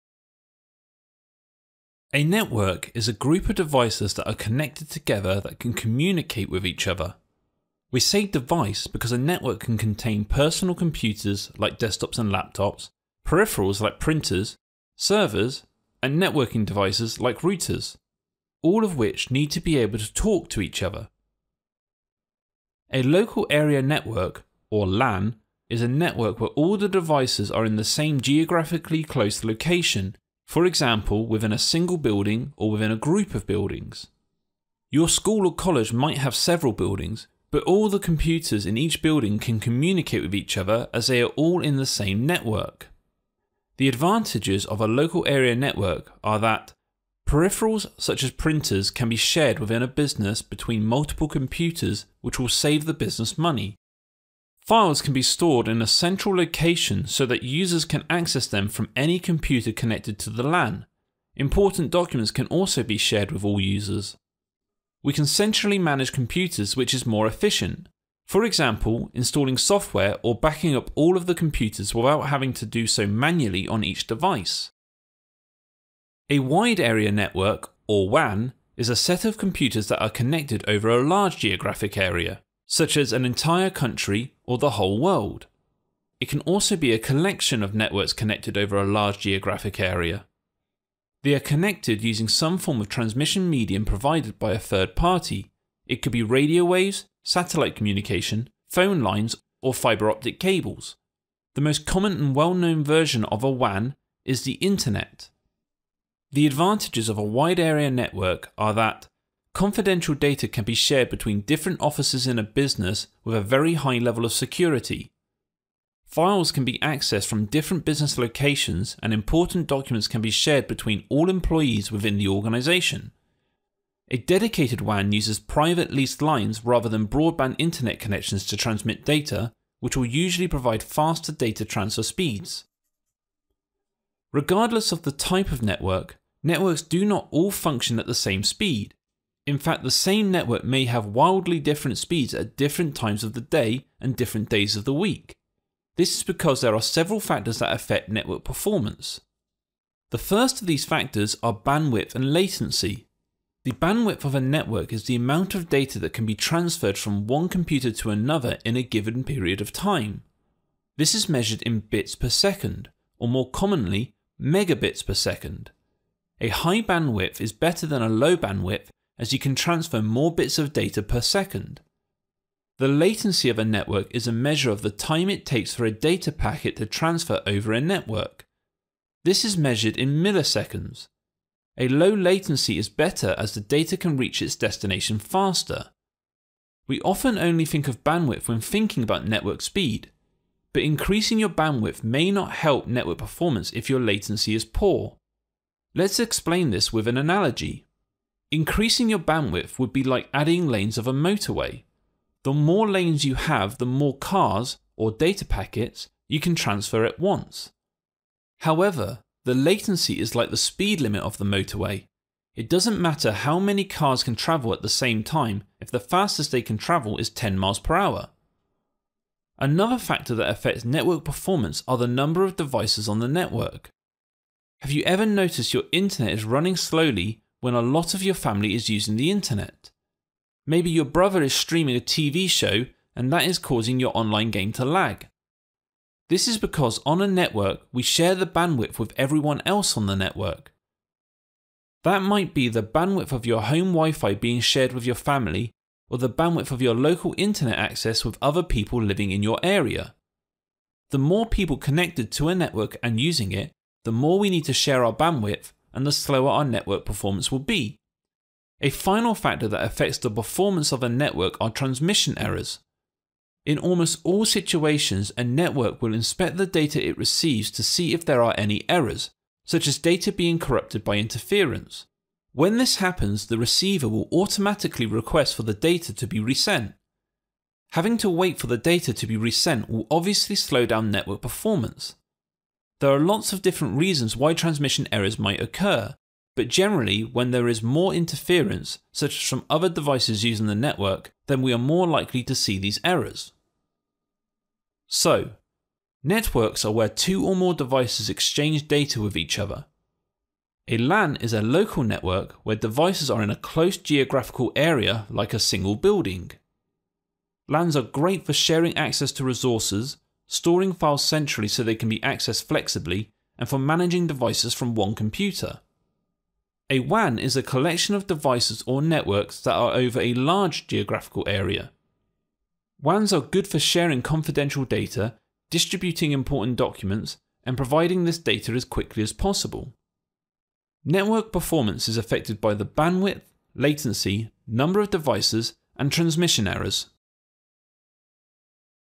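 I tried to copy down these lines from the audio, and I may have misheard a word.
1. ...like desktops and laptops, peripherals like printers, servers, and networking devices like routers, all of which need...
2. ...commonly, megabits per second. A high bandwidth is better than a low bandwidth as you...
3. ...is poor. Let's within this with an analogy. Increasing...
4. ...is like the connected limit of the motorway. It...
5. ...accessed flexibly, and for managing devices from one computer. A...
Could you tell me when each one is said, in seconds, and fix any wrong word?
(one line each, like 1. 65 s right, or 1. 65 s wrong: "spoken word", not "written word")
1. 11 s right
2. 163 s right
3. 194 s wrong: "explain", not "within"
4. 210 s wrong: "speed", not "connected"
5. 312 s right.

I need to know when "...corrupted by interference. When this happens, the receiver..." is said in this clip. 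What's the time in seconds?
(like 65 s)
270 s.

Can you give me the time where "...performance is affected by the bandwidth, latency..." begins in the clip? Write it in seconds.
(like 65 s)
331 s.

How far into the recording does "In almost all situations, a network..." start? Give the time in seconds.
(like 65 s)
263 s.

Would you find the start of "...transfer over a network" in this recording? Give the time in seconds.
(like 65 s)
176 s.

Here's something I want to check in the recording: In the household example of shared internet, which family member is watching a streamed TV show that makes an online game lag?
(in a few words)
brother.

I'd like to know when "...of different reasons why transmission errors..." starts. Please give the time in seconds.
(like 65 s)
283 s.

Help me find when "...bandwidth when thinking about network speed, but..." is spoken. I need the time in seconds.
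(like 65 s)
188 s.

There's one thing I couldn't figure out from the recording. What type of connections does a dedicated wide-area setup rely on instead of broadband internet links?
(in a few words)
private leased lines.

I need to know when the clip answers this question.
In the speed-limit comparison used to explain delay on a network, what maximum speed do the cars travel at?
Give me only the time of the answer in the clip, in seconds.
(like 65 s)
217 s.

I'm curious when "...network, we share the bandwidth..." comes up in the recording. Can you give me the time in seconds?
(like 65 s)
237 s.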